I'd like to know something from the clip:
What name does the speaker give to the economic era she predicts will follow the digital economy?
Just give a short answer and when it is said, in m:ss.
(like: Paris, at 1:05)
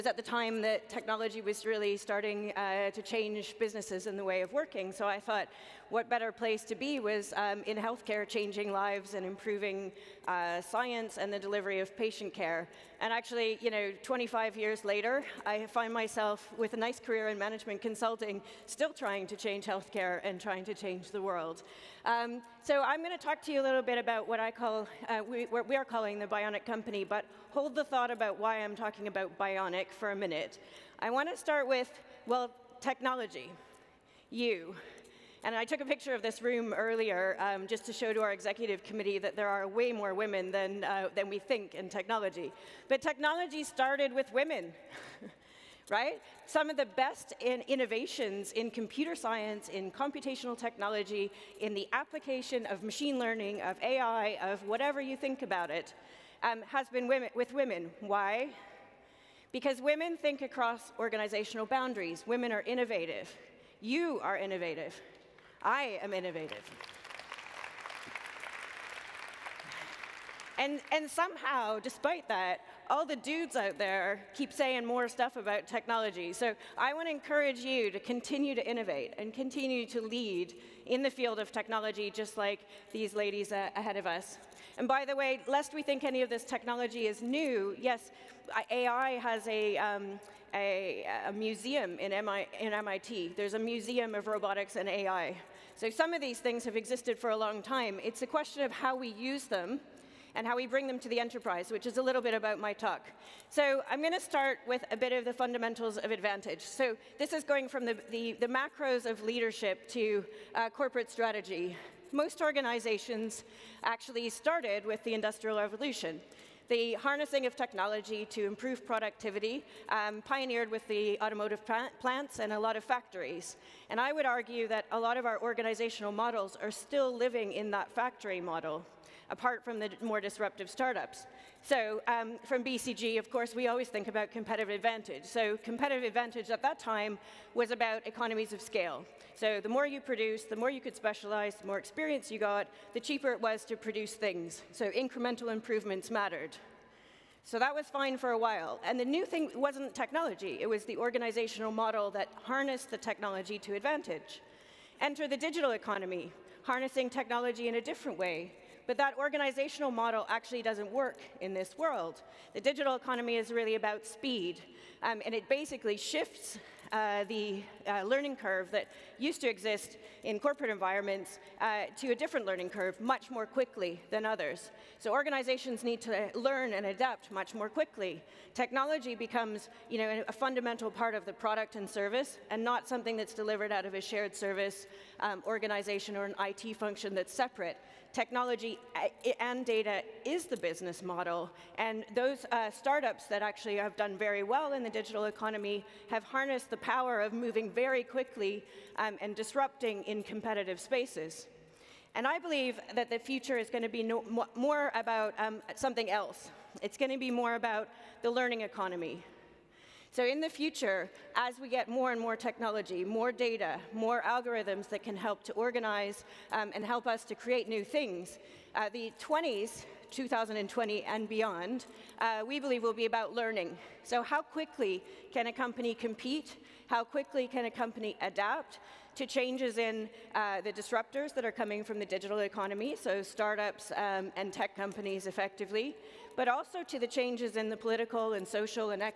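learning economy, at 3:28.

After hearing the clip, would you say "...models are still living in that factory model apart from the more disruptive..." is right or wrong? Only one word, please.
right.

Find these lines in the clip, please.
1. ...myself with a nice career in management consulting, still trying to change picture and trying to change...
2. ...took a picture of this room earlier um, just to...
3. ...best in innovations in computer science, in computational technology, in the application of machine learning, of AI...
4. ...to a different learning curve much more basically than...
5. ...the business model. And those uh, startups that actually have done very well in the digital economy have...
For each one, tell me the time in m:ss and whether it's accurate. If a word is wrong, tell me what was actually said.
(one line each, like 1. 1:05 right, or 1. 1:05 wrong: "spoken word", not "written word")
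1. 0:15 wrong: "healthcare", not "picture"
2. 0:35 right
3. 0:46 right
4. 2:51 wrong: "quickly", not "basically"
5. 3:10 right.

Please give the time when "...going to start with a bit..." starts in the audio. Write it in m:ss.
1:44.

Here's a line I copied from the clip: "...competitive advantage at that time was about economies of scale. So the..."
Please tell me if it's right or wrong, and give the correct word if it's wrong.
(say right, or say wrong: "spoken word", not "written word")
right.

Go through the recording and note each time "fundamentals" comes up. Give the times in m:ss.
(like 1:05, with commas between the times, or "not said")
1:45, 3:00.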